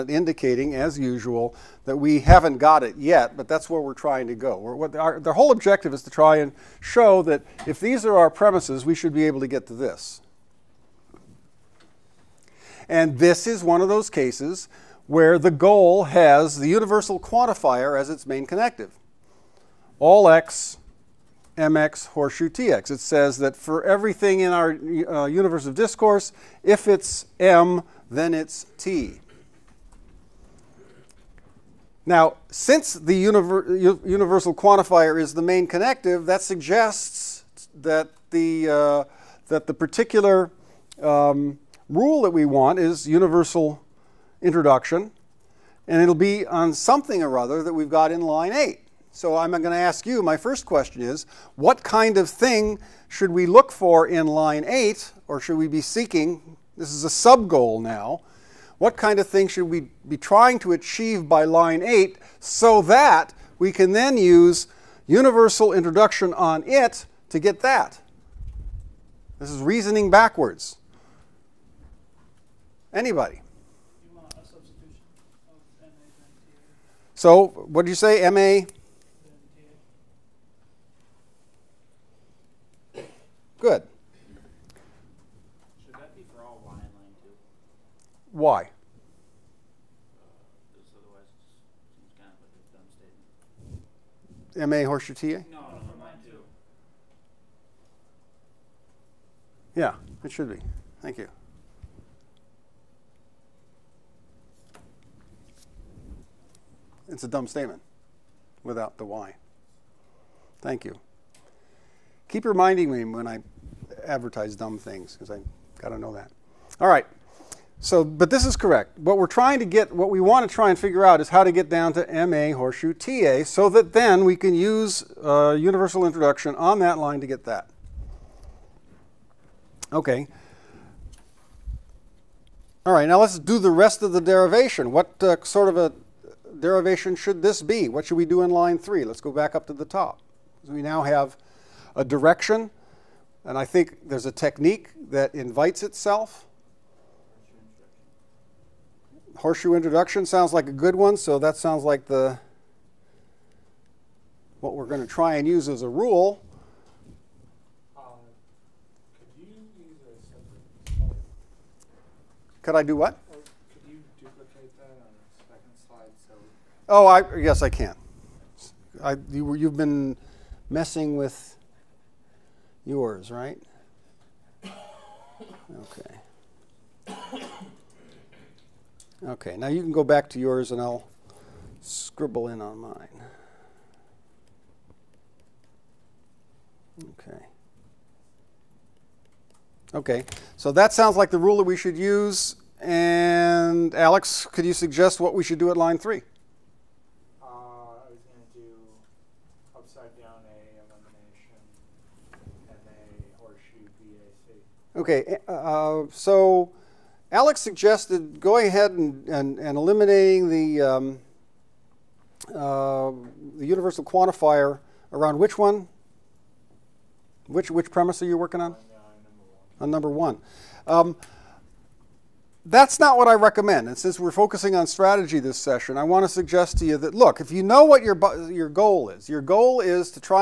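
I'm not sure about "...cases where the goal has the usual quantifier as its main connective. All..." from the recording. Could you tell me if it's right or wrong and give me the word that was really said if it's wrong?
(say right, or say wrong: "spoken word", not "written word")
wrong: "universal", not "usual".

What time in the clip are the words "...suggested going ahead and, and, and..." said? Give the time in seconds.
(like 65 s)
207 s.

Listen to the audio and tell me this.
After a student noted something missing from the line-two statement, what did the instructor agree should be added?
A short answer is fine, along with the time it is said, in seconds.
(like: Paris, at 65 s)
for all Y, at 86 s.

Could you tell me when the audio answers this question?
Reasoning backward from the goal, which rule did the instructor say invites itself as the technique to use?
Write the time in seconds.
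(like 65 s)
149 s.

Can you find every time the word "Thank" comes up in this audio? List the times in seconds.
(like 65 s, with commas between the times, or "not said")
101 s, 110 s.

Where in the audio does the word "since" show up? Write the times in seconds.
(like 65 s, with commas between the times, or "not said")
32 s, 223 s.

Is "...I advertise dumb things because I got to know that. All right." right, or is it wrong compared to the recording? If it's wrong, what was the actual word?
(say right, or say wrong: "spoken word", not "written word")
right.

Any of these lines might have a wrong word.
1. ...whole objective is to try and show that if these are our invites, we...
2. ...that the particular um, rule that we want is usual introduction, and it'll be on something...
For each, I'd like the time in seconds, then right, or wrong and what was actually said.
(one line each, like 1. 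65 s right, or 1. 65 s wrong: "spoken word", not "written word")
1. 5 s wrong: "premises", not "invites"
2. 39 s wrong: "universal", not "usual".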